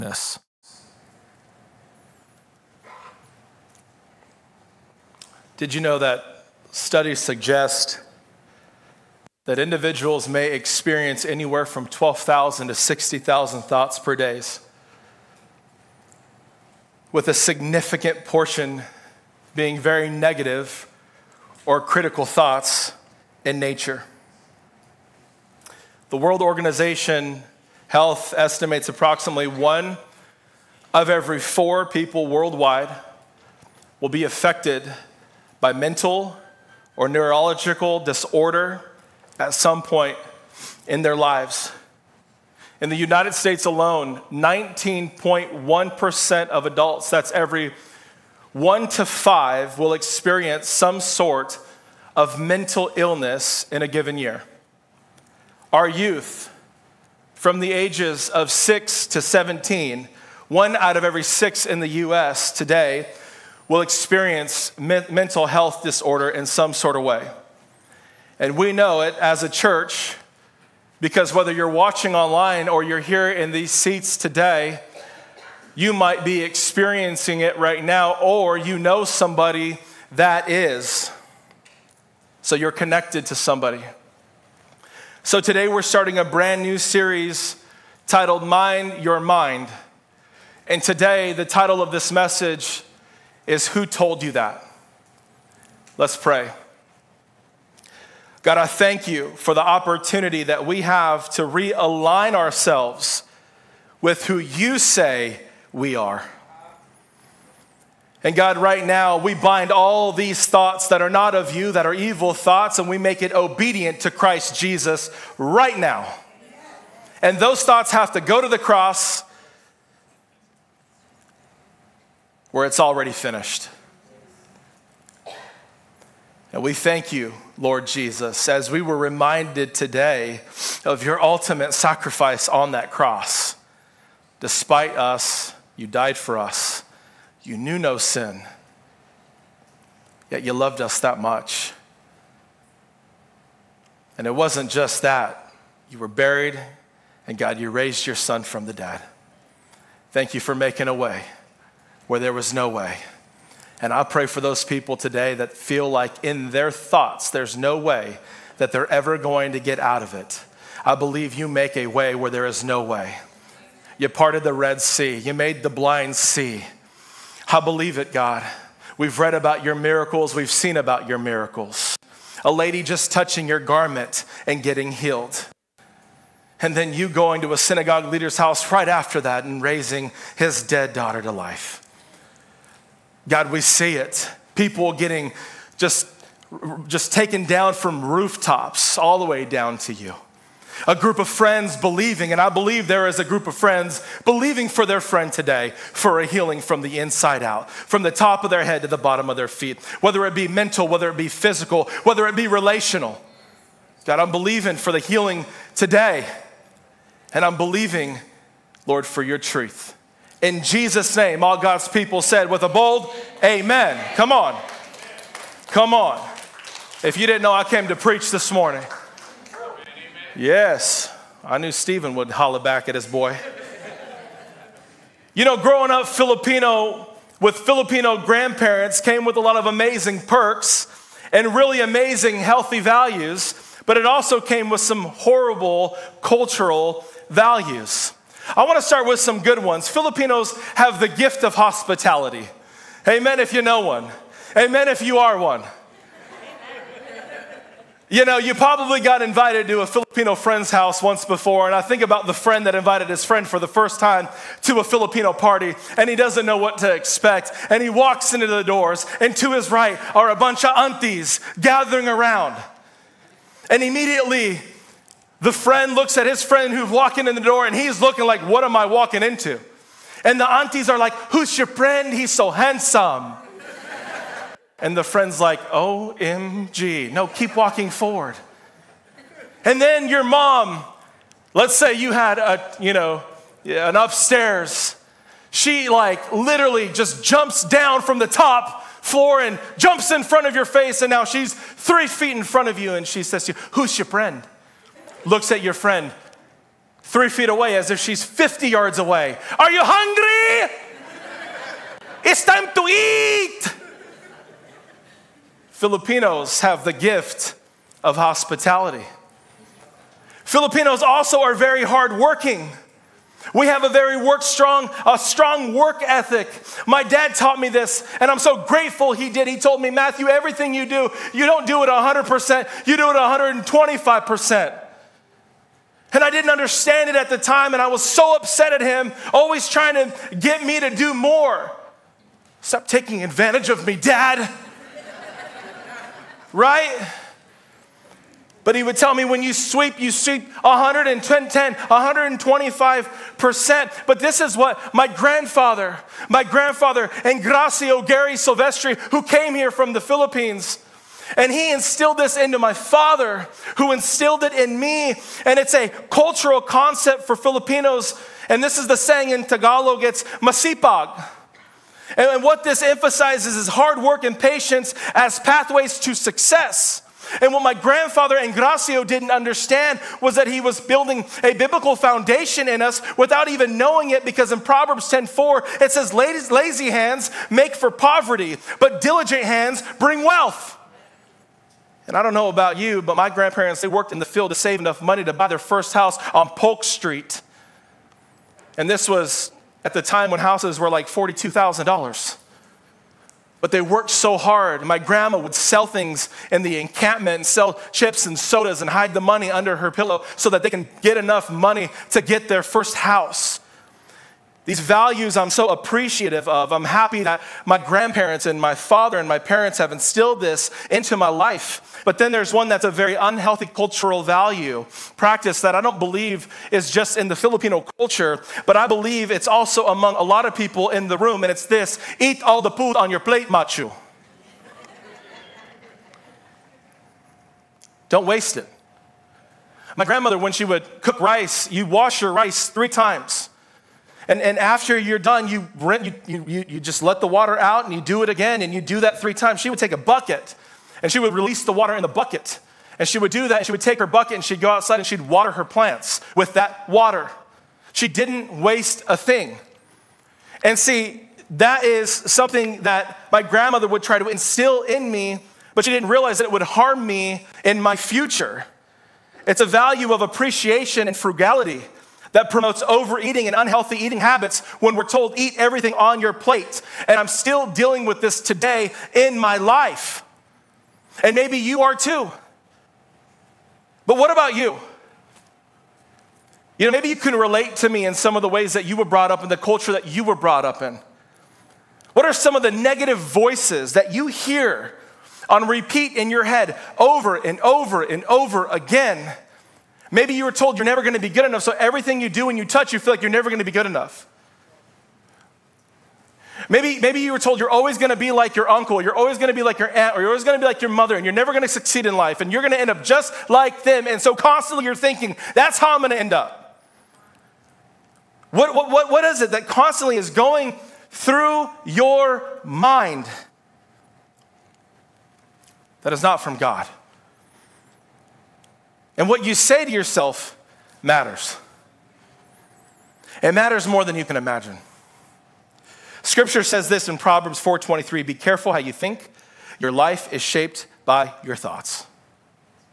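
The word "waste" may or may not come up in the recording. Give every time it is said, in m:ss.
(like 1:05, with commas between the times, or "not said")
7:08, 7:28.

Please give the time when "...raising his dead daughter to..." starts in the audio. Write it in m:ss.
2:59.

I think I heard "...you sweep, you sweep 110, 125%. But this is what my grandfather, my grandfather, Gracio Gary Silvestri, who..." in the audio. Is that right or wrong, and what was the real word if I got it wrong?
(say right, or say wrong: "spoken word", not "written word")
right.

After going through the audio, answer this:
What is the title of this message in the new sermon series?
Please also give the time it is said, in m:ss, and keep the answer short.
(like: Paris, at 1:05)
Who Told You That?, at 1:33.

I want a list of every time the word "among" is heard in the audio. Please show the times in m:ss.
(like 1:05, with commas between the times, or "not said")
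6:59.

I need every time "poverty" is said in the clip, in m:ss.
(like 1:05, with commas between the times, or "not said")
6:17.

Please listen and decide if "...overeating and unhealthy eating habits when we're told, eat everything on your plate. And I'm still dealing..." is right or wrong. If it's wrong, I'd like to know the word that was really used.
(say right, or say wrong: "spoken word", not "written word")
right.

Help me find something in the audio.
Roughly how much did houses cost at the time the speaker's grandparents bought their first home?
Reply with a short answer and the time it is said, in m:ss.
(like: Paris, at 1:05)
$42,000, at 6:31.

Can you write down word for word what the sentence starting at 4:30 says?
And the aunties are like, Who's your friend?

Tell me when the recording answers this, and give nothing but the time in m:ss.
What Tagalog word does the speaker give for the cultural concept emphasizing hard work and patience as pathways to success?
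6:00.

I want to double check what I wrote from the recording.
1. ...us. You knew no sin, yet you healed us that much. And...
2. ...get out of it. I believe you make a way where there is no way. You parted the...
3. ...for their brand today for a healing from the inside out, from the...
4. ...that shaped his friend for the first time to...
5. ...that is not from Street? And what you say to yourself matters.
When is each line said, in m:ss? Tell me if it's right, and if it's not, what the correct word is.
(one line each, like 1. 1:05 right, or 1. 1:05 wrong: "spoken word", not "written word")
1. 2:16 wrong: "loved", not "healed"
2. 2:39 right
3. 3:14 wrong: "friend", not "brand"
4. 4:12 wrong: "invited", not "shaped"
5. 8:36 wrong: "God", not "Street".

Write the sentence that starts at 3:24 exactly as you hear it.
God, I'm believing for the healing today, and I'm believing, Lord, for your truth.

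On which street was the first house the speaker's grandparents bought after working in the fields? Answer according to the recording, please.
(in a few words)
Polk Street.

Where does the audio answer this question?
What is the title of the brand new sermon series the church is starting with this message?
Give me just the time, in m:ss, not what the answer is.
1:28.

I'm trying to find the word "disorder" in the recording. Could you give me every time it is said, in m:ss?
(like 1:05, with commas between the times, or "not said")
0:38, 1:05.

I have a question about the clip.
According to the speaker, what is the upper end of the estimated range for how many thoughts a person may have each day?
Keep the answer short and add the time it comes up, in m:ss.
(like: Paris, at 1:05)
60,000, at 0:12.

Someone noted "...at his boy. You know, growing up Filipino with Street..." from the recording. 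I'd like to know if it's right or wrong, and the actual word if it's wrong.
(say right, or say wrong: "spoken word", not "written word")
wrong: "Filipino", not "Street".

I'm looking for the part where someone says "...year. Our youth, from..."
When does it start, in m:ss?
0:54.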